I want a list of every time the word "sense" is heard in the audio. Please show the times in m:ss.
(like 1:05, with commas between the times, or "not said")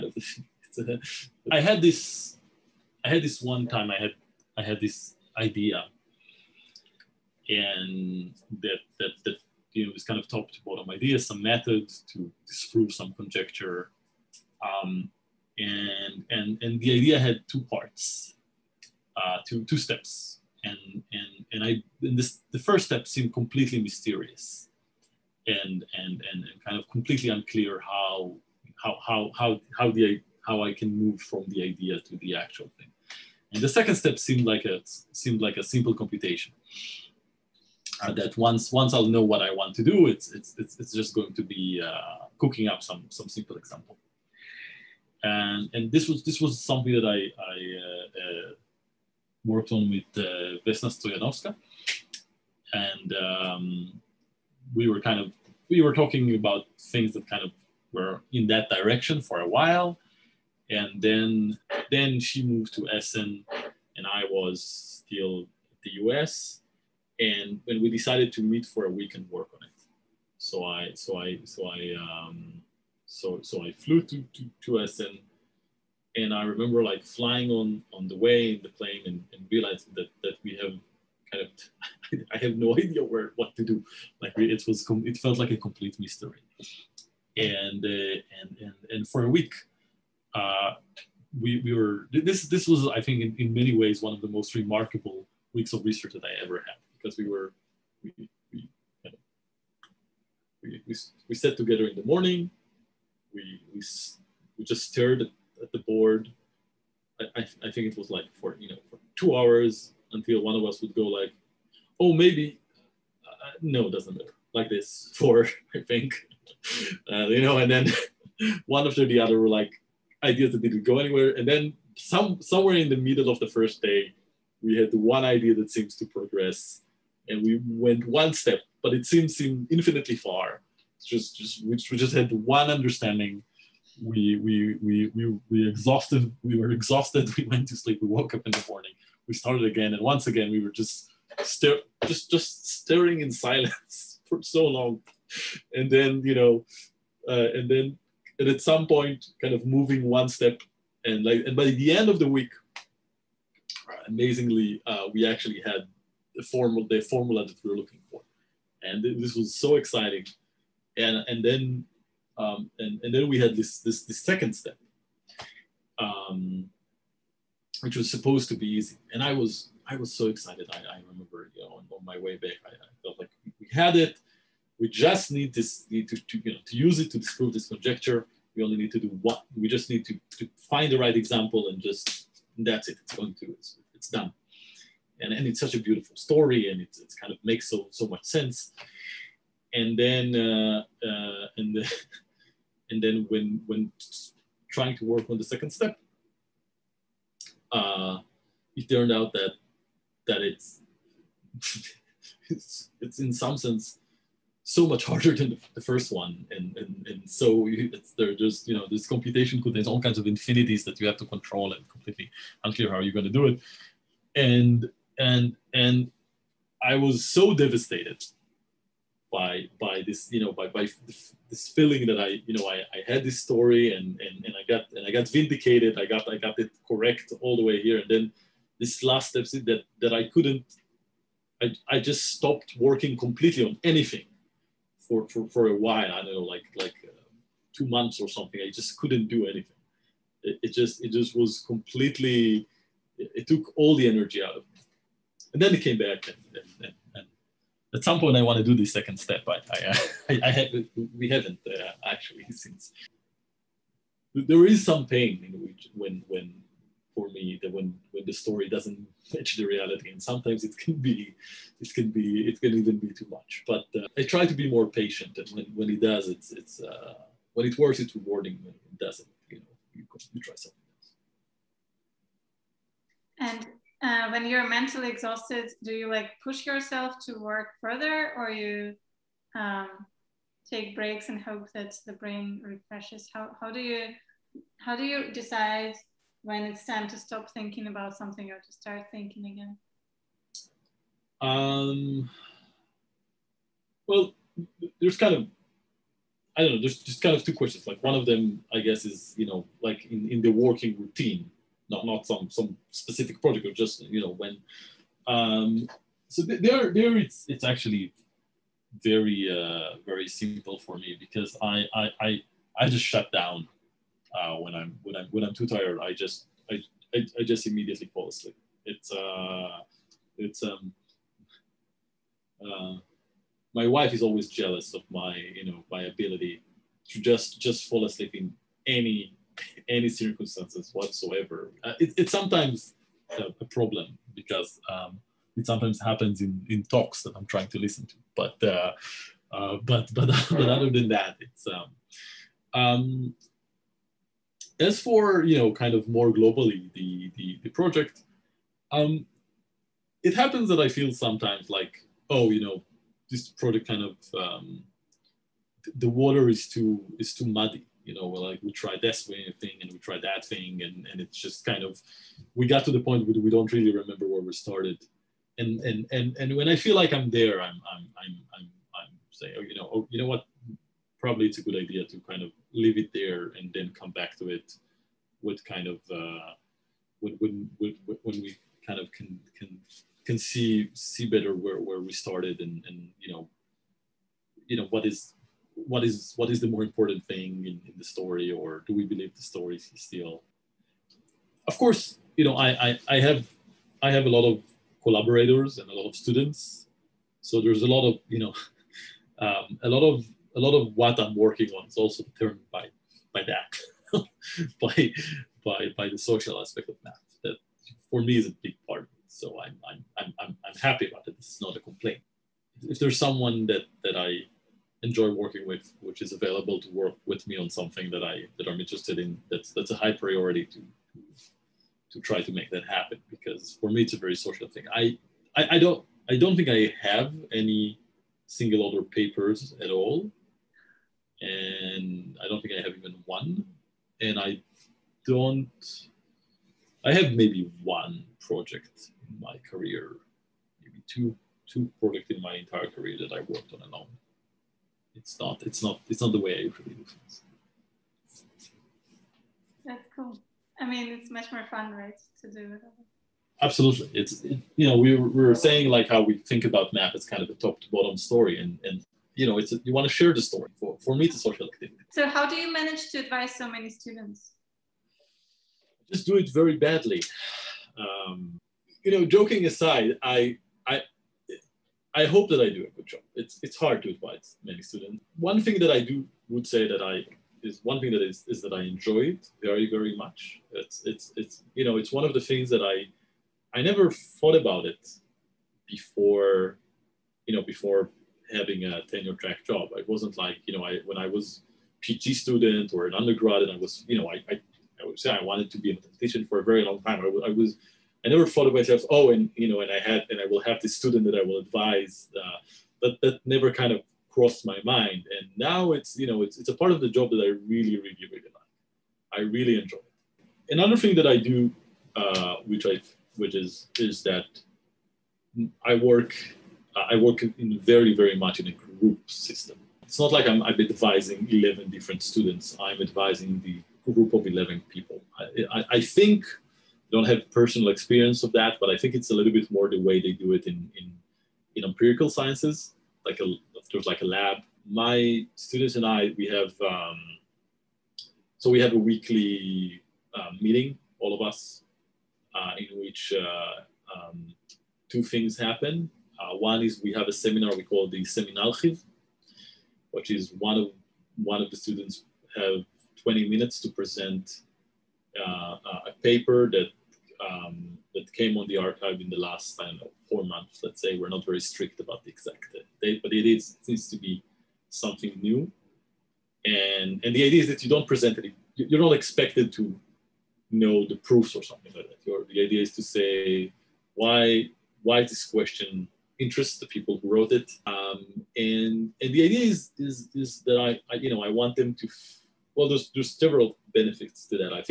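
3:08, 3:23.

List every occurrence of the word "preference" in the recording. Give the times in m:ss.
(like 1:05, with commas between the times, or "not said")
not said.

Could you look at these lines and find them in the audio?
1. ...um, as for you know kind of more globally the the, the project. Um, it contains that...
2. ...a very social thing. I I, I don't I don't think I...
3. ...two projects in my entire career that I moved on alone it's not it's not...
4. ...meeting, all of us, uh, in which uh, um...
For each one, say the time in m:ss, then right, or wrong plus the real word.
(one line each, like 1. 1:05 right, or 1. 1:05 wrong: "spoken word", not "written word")
1. 5:42 wrong: "happens", not "contains"
2. 7:04 right
3. 7:21 wrong: "worked", not "moved"
4. 9:00 right.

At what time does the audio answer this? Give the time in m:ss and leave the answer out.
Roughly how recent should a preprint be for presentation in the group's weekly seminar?
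9:20.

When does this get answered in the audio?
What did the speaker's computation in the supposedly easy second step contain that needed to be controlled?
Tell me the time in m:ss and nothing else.
3:30.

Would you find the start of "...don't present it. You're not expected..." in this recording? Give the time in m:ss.
9:27.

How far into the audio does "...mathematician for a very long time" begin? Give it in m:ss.
8:15.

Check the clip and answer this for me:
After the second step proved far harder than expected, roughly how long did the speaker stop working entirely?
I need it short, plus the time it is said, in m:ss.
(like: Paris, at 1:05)
2 months, at 3:57.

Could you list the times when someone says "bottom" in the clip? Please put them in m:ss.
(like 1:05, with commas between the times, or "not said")
0:10, 7:37.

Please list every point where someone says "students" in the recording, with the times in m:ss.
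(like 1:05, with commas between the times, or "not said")
6:36, 7:43, 7:54, 8:12, 8:20, 8:42, 8:55, 9:11.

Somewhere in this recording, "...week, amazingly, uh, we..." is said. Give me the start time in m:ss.
2:32.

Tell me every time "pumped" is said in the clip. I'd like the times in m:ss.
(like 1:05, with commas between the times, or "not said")
not said.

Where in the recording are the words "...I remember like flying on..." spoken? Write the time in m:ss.
1:16.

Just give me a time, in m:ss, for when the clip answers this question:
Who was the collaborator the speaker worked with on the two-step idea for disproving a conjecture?
0:50.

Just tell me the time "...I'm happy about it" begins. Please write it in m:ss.
6:50.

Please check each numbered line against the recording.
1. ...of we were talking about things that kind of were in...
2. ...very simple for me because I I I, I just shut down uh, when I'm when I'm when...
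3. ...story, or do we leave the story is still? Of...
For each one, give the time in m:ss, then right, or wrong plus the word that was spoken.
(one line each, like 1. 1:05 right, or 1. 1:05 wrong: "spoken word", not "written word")
1. 0:55 right
2. 5:10 right
3. 6:28 wrong: "believe", not "leave".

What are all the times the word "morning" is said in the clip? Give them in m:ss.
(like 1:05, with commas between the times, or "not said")
1:42, 2:18.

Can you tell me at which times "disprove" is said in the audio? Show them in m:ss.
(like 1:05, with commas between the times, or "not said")
0:12, 2:57.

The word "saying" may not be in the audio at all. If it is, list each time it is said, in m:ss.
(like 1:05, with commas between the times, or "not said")
6:09, 7:35.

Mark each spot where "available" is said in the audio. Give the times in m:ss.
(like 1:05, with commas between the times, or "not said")
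6:56.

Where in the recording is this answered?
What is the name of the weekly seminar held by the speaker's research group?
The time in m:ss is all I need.
9:08.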